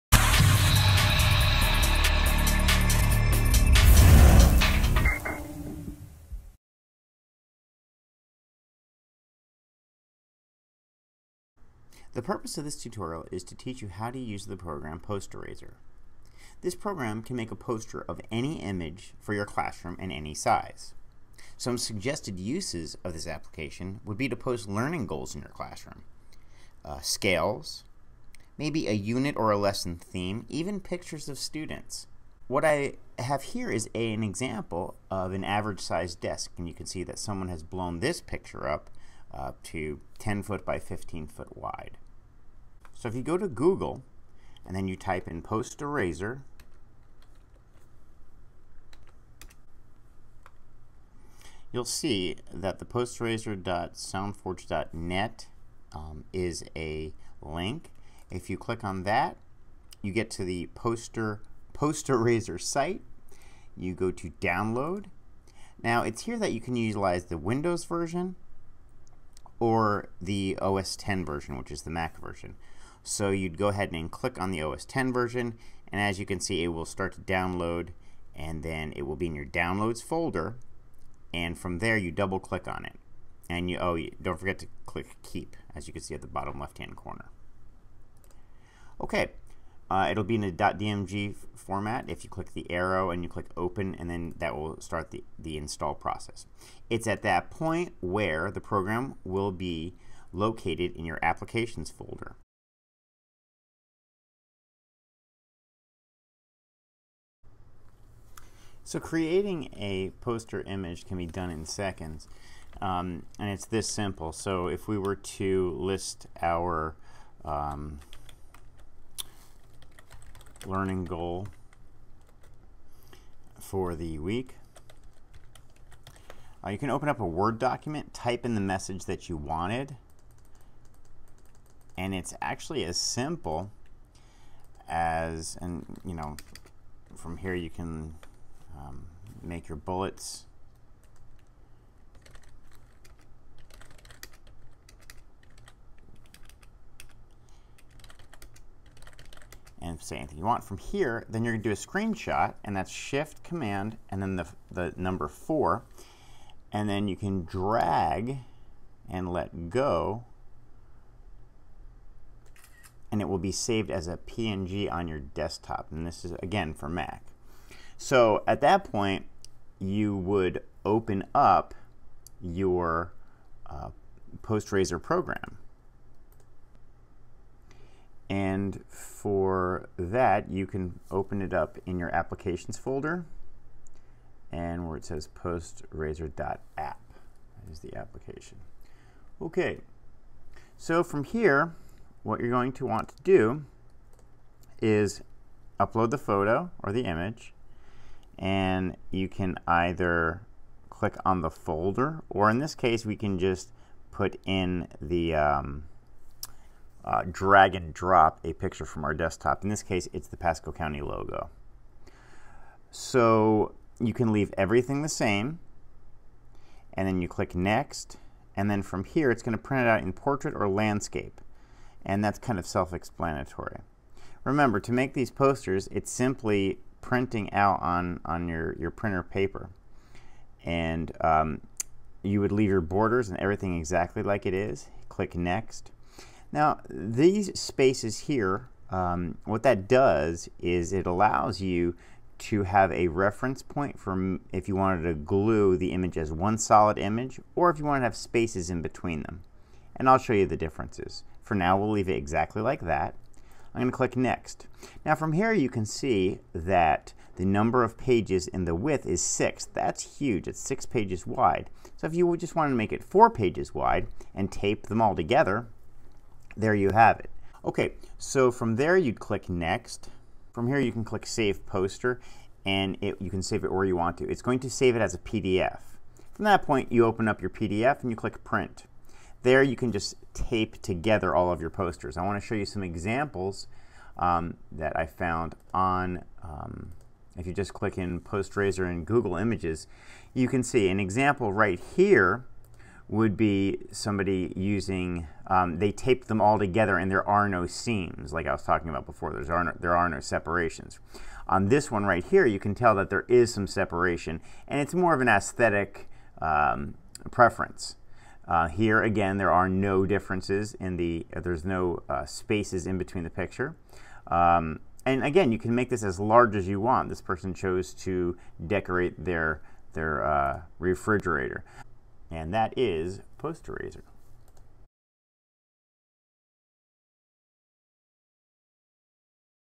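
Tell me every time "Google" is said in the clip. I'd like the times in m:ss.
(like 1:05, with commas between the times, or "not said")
0:43, 4:49.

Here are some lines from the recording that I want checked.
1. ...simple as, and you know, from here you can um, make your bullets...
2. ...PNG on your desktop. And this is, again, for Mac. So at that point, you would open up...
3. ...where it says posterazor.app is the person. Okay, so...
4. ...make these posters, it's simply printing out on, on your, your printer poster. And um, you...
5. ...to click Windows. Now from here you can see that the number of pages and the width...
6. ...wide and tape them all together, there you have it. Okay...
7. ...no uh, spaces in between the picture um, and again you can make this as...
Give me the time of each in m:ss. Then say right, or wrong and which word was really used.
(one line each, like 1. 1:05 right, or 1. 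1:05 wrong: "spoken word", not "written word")
1. 2:12 right
2. 2:44 right
3. 3:04 wrong: "application", not "person"
4. 3:44 wrong: "paper", not "poster"
5. 4:13 wrong: "Next", not "Windows"
6. 4:23 right
7. 5:11 right.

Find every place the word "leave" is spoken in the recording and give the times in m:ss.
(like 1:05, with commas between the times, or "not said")
3:34, 3:52, 4:11.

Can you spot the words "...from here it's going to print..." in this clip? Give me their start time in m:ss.
3:38.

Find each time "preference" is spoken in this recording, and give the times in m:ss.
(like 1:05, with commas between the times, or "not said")
5:07.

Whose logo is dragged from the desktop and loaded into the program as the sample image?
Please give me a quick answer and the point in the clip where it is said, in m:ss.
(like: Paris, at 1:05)
Pasco County, at 3:30.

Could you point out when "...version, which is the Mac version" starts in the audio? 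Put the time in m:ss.
1:11.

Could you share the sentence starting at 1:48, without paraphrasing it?
So creating a poster image can be done in seconds um, and it's this simple.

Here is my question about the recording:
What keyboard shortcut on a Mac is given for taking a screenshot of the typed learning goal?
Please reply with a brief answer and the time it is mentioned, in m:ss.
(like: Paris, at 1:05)
Shift, Command, 4, at 2:32.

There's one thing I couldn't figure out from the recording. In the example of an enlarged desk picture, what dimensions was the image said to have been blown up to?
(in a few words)
10 foot by 15 foot.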